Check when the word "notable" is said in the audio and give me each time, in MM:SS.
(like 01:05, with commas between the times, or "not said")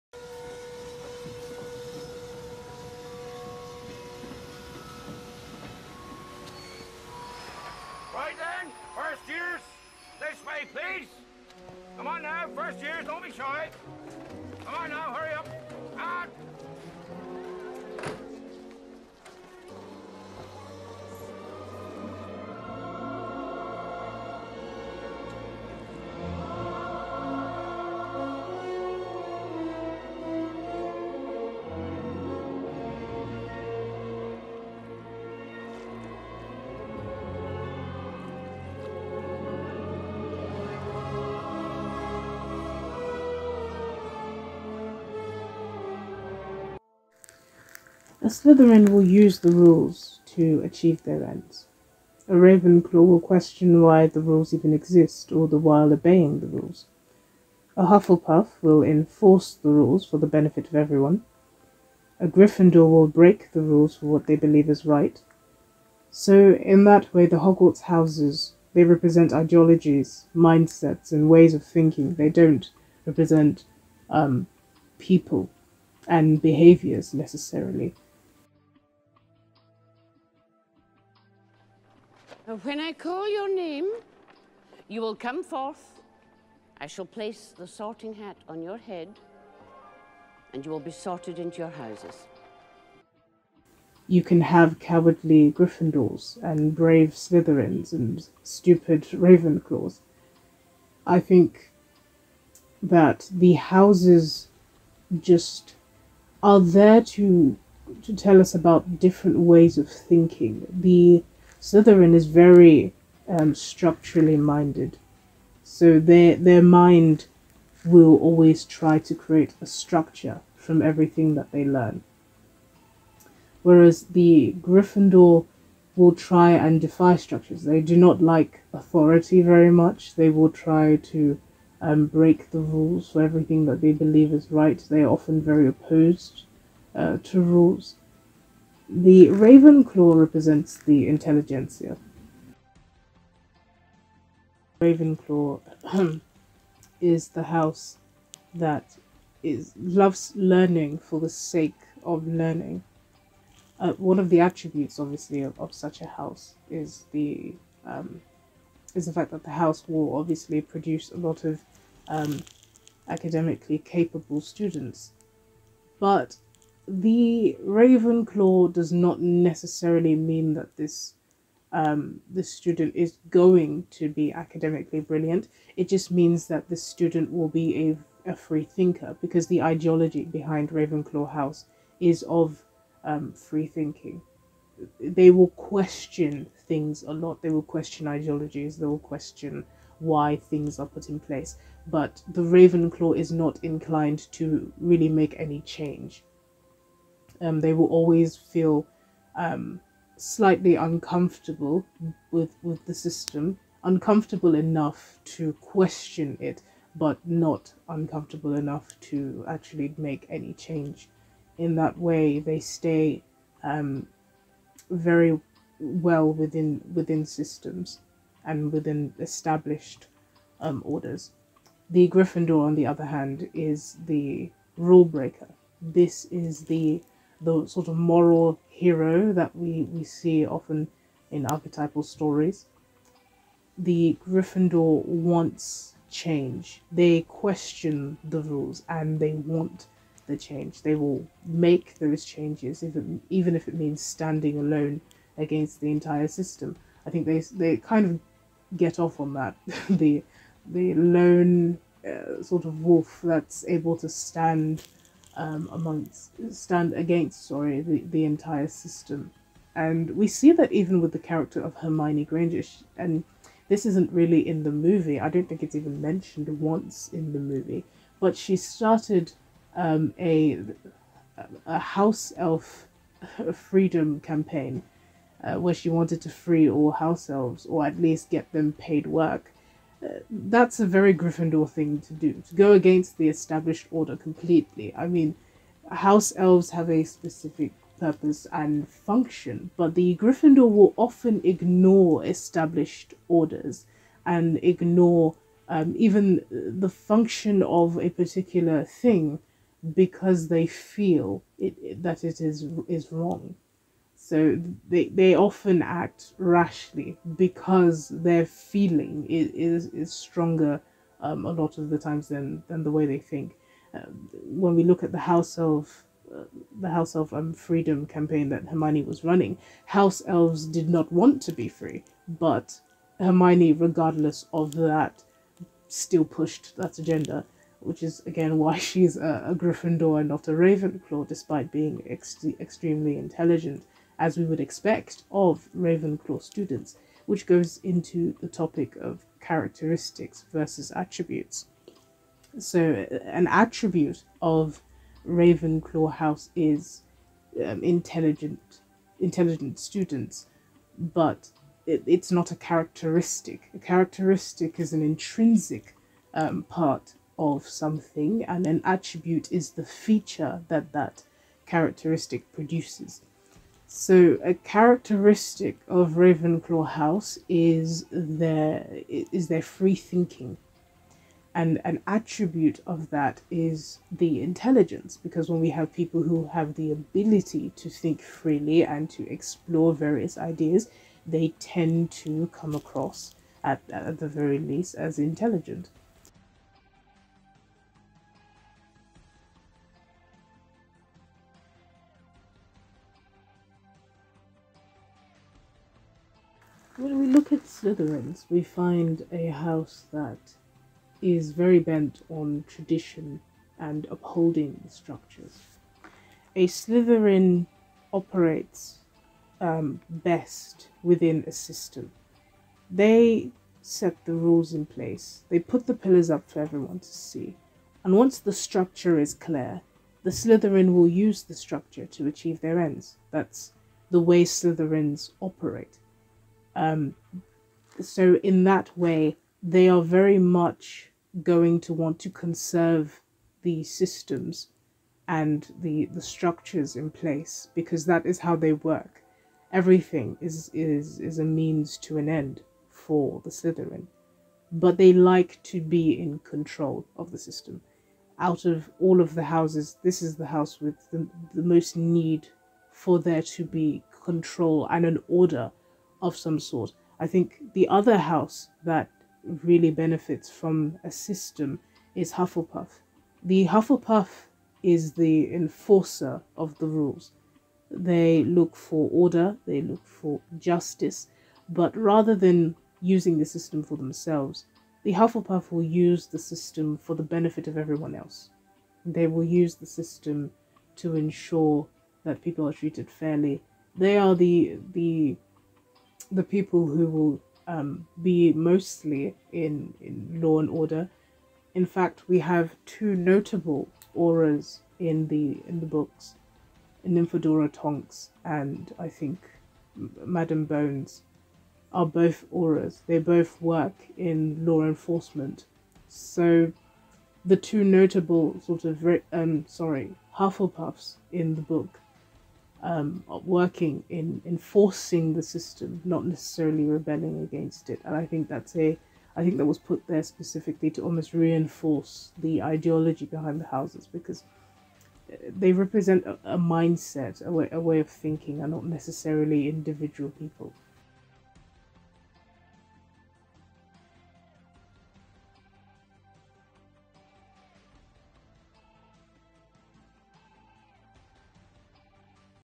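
08:13, 08:27.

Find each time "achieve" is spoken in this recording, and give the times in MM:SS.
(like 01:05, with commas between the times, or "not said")
00:50, 07:02.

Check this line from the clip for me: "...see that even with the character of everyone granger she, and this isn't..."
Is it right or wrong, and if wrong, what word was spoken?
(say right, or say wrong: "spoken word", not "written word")
wrong: "hermione", not "everyone".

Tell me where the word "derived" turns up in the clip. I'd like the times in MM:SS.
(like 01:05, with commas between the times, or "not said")
not said.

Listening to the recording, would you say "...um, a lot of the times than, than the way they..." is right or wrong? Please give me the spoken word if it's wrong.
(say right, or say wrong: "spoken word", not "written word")
right.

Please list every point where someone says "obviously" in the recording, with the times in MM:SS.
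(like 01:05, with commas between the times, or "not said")
02:34, 02:40.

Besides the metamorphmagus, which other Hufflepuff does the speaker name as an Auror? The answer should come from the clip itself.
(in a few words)
Madam Bones.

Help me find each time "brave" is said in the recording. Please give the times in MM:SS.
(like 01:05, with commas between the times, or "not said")
01:36.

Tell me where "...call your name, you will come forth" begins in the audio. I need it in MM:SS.
01:22.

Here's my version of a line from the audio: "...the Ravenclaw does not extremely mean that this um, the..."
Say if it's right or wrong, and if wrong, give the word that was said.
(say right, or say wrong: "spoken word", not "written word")
wrong: "necessarily", not "extremely".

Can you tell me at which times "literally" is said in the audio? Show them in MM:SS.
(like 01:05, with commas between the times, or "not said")
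not said.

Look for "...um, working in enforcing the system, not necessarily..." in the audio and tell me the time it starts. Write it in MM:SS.
08:32.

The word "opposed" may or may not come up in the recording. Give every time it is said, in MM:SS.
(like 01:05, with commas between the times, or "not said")
02:15.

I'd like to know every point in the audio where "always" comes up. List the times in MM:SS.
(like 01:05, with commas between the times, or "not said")
01:58, 03:17.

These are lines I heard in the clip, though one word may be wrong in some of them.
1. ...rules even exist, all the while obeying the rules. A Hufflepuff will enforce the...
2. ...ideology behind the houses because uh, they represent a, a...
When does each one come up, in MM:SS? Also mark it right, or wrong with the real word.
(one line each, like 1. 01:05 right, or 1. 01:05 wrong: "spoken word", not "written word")
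1. 00:54 right
2. 08:42 right.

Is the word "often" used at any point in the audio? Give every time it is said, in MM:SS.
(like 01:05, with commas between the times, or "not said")
02:15, 03:50, 04:50, 05:05.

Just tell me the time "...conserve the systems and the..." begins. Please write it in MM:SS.
07:12.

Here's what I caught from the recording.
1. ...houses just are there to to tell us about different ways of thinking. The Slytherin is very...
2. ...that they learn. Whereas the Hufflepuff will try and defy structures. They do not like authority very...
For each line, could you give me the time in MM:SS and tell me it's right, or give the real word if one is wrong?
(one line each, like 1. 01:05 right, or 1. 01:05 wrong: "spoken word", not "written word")
1. 01:43 right
2. 02:01 wrong: "Gryffindor", not "Hufflepuff".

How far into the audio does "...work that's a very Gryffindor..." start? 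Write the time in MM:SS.
04:39.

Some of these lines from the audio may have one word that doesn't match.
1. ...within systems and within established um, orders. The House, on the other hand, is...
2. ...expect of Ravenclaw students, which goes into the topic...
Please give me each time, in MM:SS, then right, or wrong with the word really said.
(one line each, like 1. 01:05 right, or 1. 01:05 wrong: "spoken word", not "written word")
1. 03:36 wrong: "Gryffindor", not "House"
2. 05:34 right.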